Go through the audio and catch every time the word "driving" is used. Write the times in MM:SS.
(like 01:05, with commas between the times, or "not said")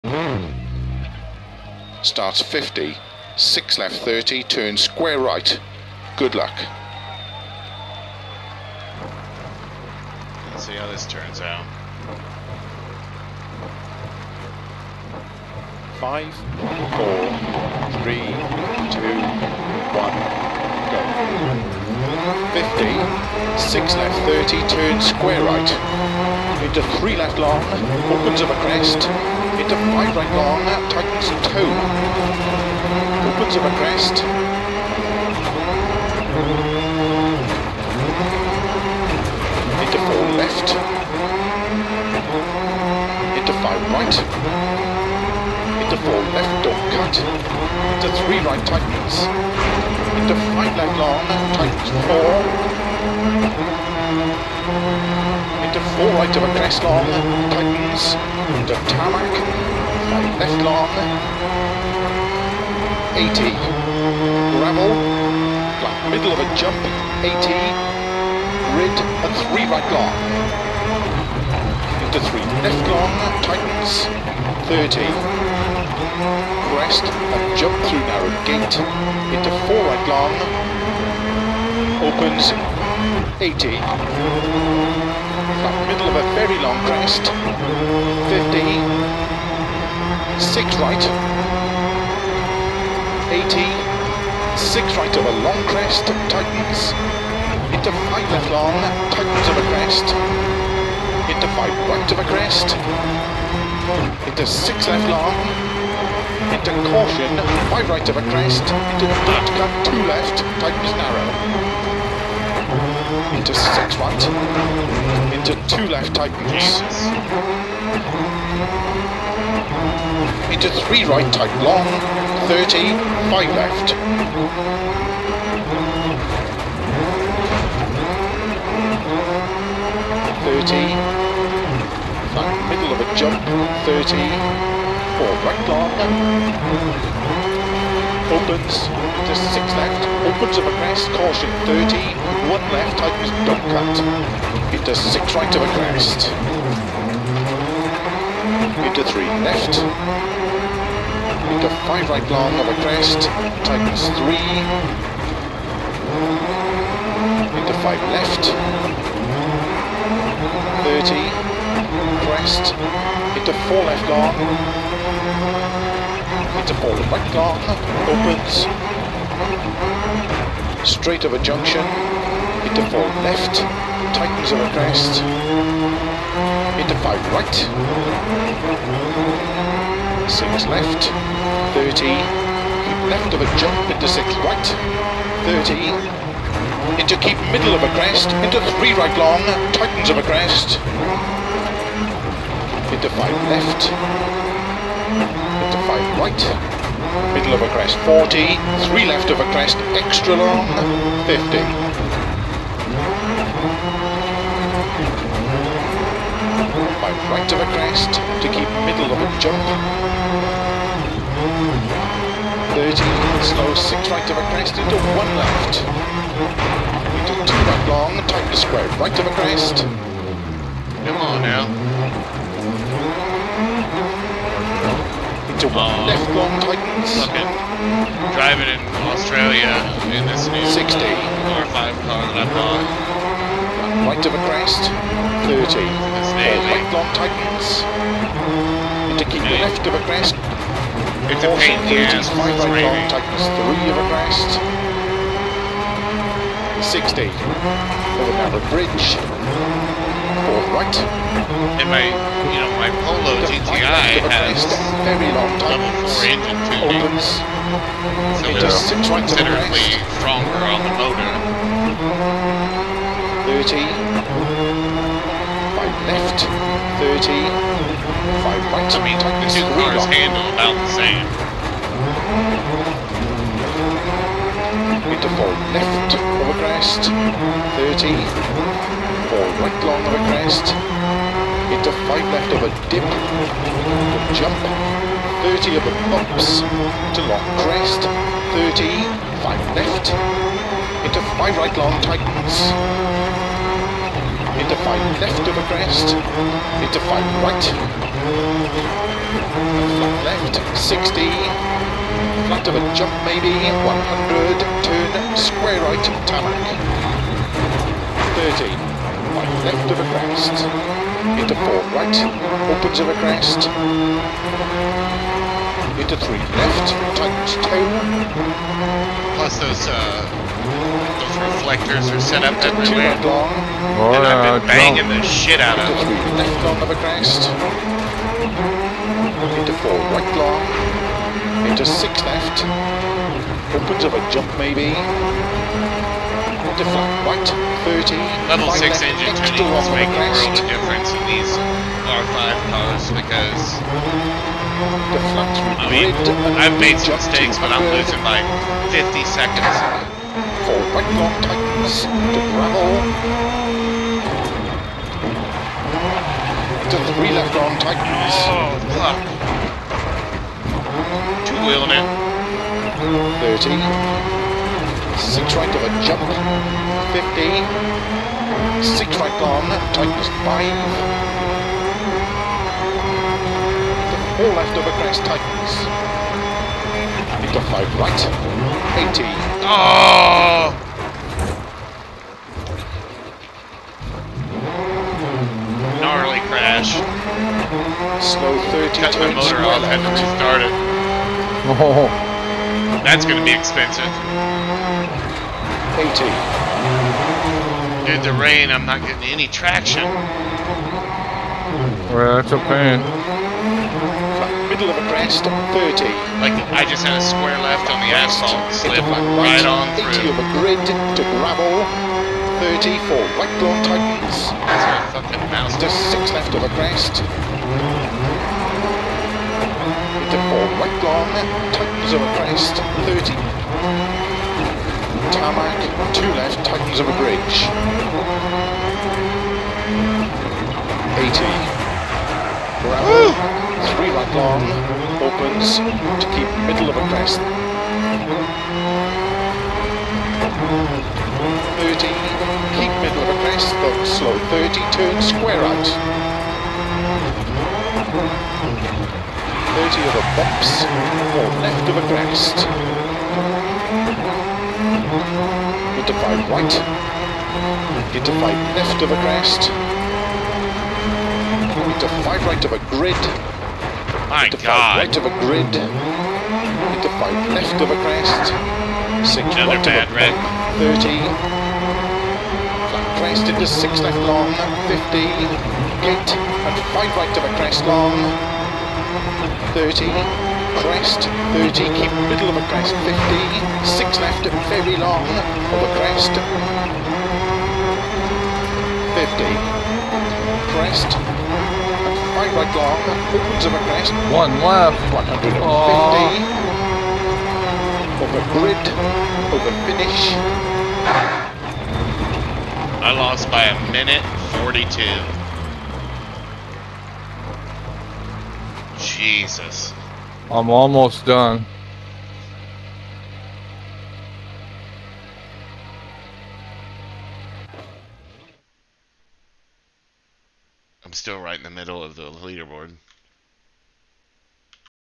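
03:48.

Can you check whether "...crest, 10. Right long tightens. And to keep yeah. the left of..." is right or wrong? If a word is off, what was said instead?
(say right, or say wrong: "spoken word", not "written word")
wrong: "30", not "10".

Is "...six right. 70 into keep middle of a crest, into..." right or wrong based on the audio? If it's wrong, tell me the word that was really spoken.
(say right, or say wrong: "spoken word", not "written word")
wrong: "30", not "70".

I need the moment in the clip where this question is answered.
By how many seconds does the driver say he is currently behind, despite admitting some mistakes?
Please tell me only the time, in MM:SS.
05:48.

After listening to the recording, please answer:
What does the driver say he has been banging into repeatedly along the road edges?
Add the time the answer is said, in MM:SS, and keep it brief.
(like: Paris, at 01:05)
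reflectors, at 05:21.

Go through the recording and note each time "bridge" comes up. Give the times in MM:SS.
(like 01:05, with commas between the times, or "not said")
04:08, 07:07.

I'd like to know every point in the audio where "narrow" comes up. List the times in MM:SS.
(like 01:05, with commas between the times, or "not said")
01:18, 01:50.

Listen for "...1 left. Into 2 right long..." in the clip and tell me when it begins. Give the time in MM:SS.
03:34.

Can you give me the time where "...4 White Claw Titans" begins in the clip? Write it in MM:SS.
07:00.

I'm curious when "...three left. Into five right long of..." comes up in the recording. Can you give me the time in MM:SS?
02:29.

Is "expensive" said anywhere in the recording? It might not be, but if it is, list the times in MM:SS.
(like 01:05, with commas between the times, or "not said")
06:33.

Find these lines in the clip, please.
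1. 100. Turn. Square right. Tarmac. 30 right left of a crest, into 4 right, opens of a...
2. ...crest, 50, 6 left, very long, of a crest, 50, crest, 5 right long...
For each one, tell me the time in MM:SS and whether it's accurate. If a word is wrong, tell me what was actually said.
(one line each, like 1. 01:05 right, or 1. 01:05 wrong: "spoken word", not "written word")
1. 05:03 right
2. 08:02 right.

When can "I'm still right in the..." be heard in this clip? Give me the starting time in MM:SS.
08:41.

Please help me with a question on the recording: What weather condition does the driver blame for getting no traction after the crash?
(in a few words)
rain.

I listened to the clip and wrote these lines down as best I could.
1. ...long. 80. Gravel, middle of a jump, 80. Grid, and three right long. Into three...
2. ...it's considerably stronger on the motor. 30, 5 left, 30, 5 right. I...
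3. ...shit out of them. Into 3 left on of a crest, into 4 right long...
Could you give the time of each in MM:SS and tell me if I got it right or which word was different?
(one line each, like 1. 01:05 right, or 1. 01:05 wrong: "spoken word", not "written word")
1. 01:00 right
2. 04:18 right
3. 05:25 right.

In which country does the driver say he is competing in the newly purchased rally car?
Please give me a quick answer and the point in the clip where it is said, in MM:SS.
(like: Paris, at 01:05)
Australia, at 03:49.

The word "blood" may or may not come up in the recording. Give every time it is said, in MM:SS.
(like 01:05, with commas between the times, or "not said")
01:49.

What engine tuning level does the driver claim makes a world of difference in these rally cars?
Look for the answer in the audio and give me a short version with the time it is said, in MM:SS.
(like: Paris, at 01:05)
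Level 6, at 05:38.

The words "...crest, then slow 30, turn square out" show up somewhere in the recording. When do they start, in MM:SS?
07:23.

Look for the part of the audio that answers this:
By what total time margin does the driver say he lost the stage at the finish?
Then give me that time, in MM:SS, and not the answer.
08:23.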